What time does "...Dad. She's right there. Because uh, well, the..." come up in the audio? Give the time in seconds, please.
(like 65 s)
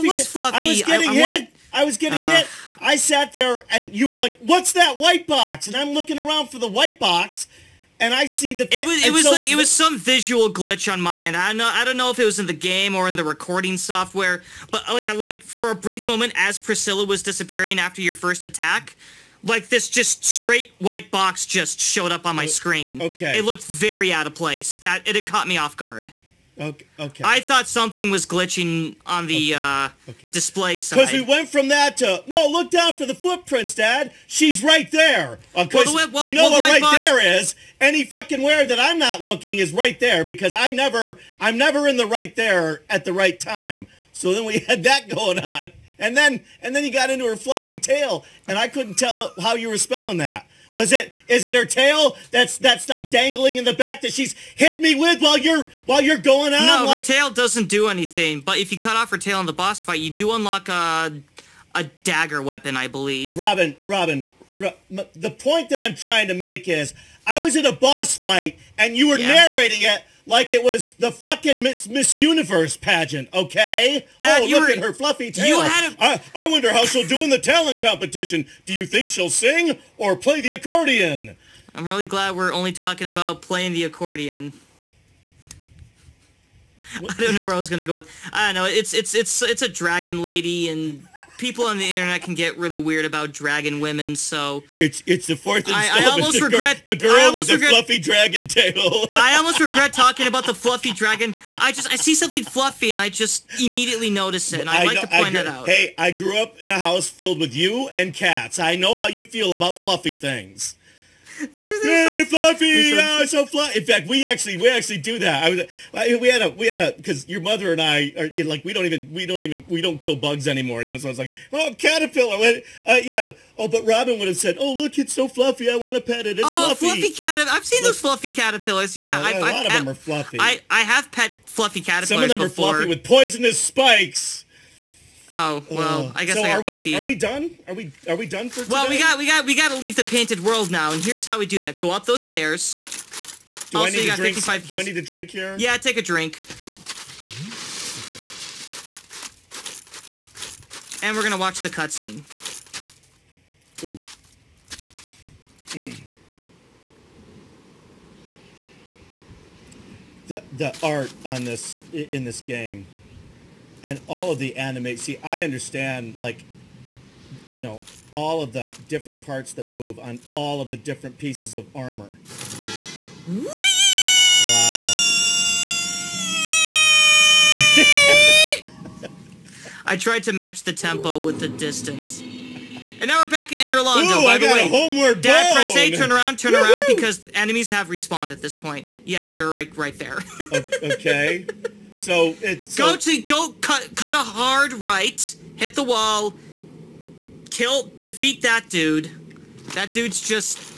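33 s.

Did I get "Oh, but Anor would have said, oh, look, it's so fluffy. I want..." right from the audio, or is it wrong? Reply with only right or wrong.
wrong.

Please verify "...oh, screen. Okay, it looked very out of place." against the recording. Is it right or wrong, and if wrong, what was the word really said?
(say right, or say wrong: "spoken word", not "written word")
right.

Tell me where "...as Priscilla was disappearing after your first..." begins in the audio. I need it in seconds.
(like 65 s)
16 s.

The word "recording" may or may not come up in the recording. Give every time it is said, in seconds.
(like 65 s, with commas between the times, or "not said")
13 s.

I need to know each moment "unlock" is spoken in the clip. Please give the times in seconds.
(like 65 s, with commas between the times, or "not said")
60 s.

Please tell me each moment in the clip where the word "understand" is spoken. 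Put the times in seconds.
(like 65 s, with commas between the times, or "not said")
165 s.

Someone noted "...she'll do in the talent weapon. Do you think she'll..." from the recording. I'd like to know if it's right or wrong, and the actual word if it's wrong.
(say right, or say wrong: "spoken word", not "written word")
wrong: "competition", not "weapon".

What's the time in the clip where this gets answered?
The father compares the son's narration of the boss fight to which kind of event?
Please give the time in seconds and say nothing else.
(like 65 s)
71 s.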